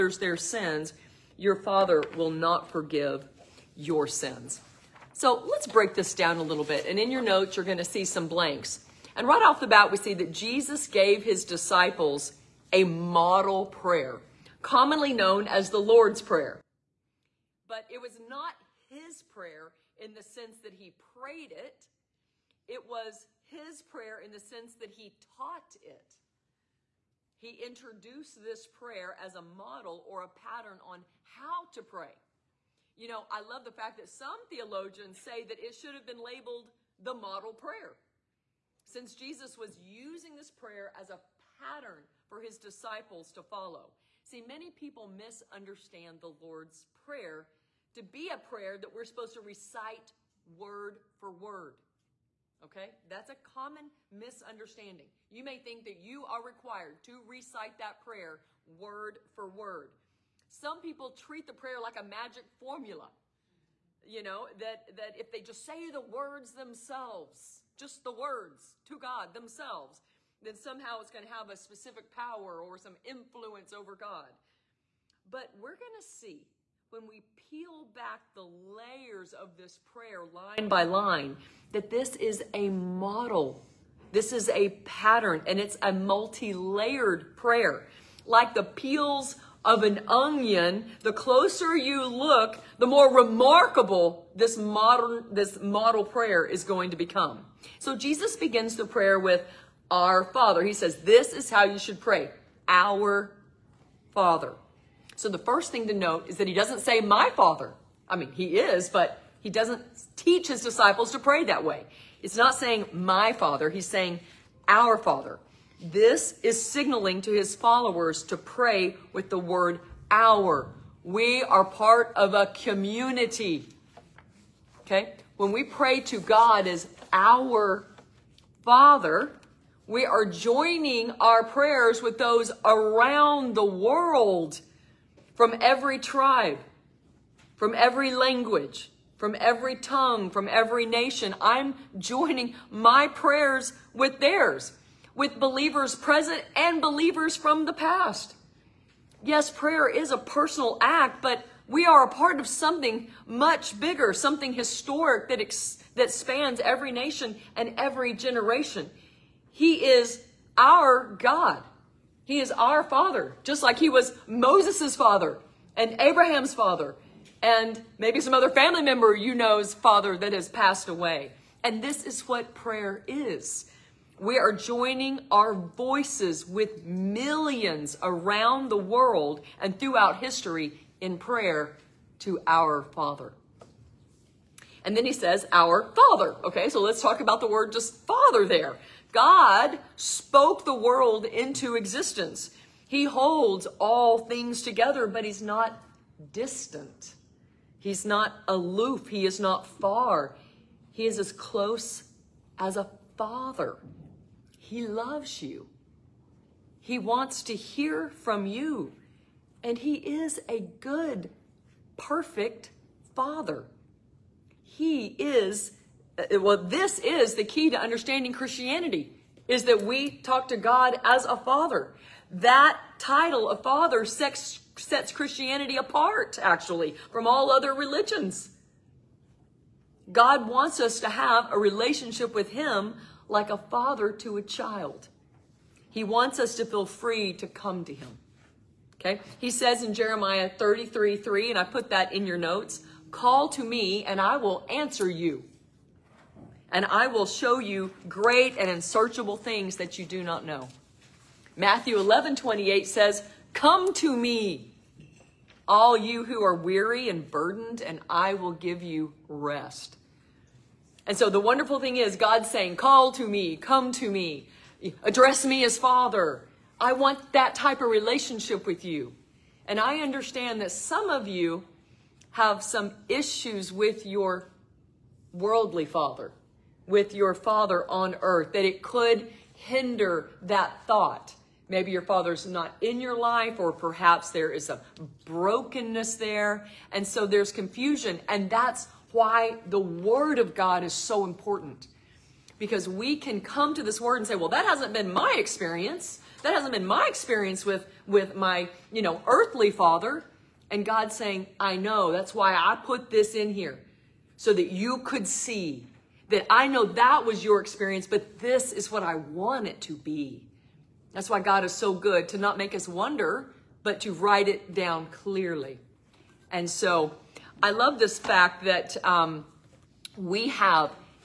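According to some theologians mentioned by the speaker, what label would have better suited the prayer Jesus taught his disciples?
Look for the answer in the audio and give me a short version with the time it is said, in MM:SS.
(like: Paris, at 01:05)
the model prayer, at 00:36.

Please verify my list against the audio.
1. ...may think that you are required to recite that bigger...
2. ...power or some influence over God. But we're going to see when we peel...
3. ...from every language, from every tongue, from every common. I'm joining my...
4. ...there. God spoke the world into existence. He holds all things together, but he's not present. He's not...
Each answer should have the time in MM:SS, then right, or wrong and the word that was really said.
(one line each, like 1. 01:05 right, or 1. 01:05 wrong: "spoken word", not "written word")
1. 00:55 wrong: "prayer", not "bigger"
2. 01:12 right
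3. 02:17 wrong: "nation", not "common"
4. 03:08 wrong: "distant", not "present".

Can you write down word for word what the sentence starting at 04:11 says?
Matthew 11, 28 says, Come to me, all you who are weary and burdened, and I will give you rest.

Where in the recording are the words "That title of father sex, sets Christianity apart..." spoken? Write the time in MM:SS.
03:42.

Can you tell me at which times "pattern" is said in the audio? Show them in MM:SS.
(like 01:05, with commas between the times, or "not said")
00:30, 00:41, 01:24.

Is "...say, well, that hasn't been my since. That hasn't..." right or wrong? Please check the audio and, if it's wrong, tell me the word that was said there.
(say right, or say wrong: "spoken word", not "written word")
wrong: "experience", not "since".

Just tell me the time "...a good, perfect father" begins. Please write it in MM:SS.
03:30.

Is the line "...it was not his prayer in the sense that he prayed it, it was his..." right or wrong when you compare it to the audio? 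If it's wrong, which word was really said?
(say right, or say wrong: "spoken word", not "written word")
right.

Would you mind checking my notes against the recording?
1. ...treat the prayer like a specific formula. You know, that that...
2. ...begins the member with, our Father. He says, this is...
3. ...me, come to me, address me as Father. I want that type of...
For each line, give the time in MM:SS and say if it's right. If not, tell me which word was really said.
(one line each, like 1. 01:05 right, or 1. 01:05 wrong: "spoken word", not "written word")
1. 01:01 wrong: "magic", not "specific"
2. 01:38 wrong: "prayer", not "member"
3. 04:23 right.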